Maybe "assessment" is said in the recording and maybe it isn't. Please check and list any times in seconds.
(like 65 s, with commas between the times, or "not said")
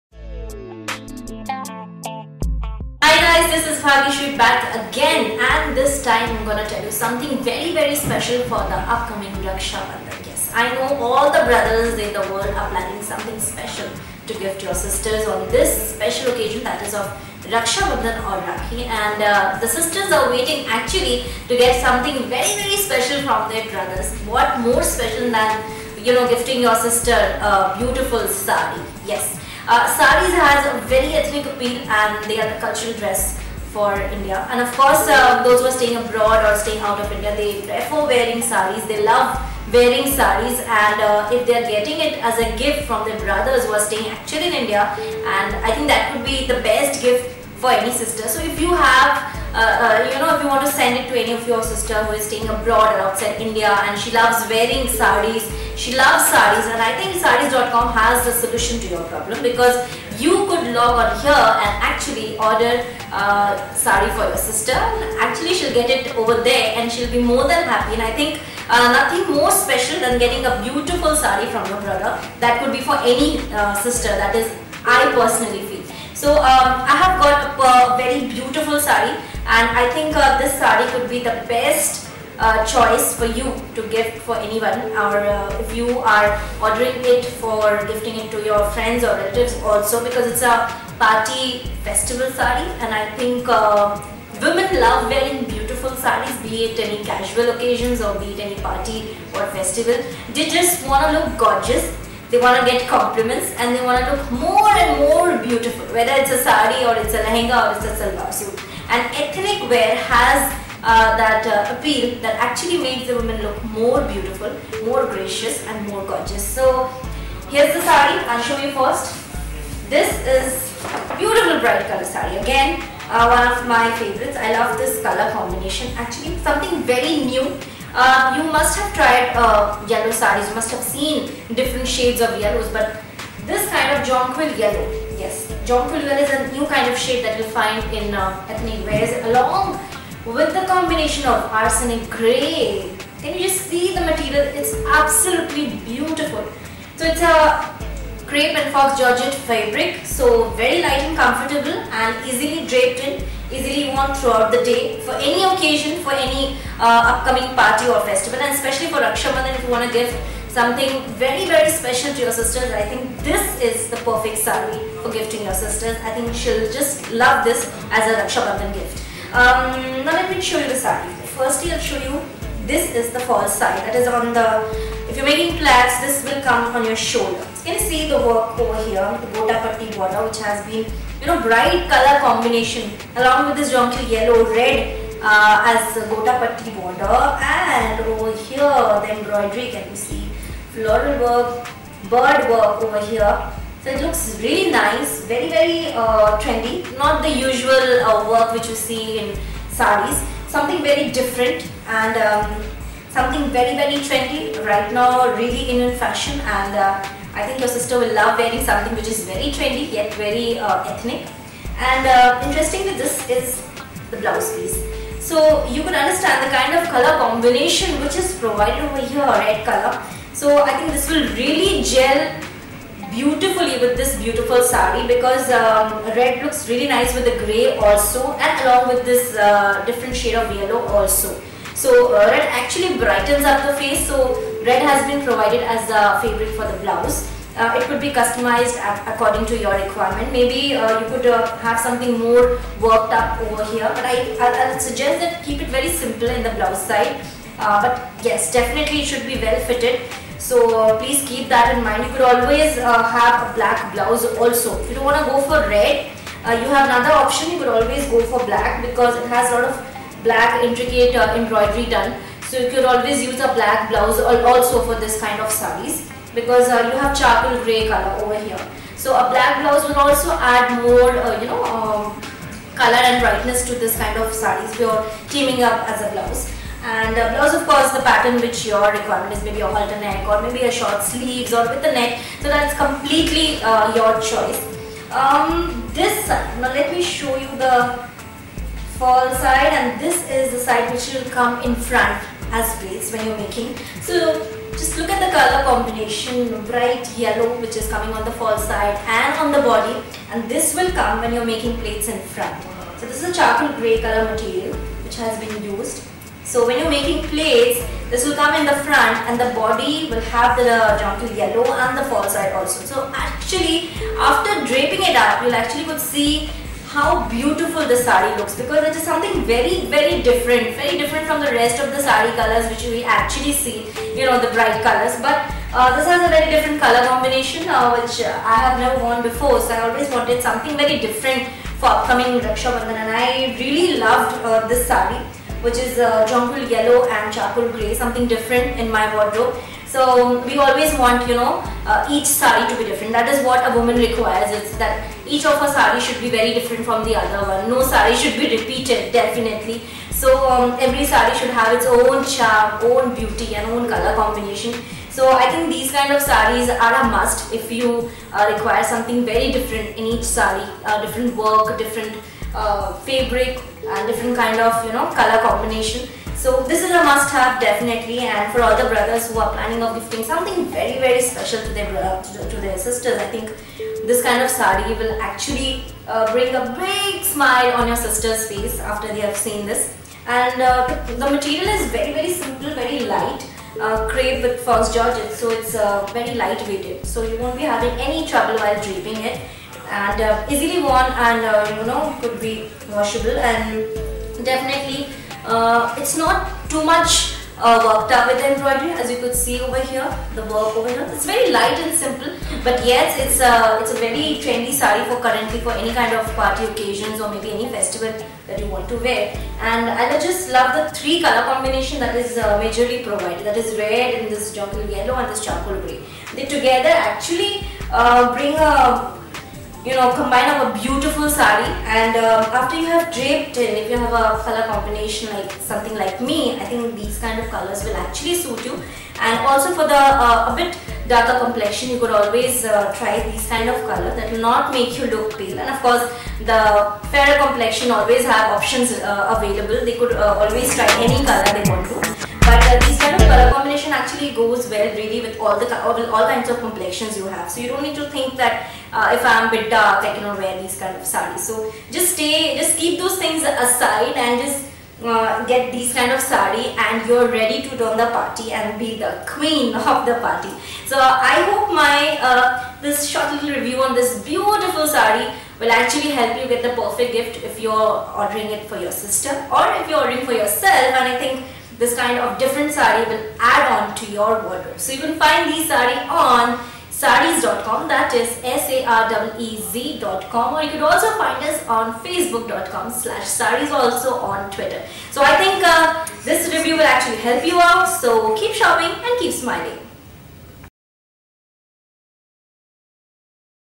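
not said.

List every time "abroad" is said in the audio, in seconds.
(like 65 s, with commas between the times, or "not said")
35 s, 52 s.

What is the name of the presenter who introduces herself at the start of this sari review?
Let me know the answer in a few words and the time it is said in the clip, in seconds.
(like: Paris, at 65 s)
Bhagishri, at 3 s.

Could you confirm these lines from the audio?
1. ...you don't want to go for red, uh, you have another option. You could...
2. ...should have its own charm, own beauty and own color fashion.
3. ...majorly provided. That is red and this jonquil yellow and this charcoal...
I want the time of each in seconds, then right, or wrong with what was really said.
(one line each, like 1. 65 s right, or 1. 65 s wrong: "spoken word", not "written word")
1. 254 s right
2. 351 s wrong: "combination", not "fashion"
3. 412 s right.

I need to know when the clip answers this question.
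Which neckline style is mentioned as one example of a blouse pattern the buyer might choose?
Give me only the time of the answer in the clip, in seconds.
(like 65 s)
279 s.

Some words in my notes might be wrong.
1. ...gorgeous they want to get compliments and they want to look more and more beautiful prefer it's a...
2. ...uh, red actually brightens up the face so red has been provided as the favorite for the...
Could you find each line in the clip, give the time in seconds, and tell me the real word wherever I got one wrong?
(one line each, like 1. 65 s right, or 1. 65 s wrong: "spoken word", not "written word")
1. 101 s wrong: "whether", not "prefer"
2. 232 s right.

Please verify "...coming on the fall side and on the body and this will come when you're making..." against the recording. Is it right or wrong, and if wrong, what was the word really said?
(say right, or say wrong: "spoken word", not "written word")
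right.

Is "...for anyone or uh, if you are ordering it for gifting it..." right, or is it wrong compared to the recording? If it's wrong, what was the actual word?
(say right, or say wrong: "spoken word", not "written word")
right.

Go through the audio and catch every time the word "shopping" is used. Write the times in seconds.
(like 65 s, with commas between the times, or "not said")
488 s.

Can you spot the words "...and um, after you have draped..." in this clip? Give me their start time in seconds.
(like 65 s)
421 s.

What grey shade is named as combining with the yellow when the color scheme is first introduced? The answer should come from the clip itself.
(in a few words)
Arsenic grey.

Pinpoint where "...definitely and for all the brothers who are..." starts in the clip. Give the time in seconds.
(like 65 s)
367 s.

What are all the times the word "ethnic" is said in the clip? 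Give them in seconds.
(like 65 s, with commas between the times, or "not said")
31 s, 109 s, 138 s, 210 s.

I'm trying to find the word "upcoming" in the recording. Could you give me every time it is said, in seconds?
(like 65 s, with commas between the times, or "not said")
8 s, 157 s, 331 s.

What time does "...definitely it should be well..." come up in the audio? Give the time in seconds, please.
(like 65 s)
248 s.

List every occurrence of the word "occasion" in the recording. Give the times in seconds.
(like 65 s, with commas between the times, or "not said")
16 s, 97 s, 155 s, 406 s.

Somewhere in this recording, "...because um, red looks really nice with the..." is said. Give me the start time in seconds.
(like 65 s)
225 s.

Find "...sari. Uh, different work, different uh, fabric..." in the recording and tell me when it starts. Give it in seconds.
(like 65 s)
360 s.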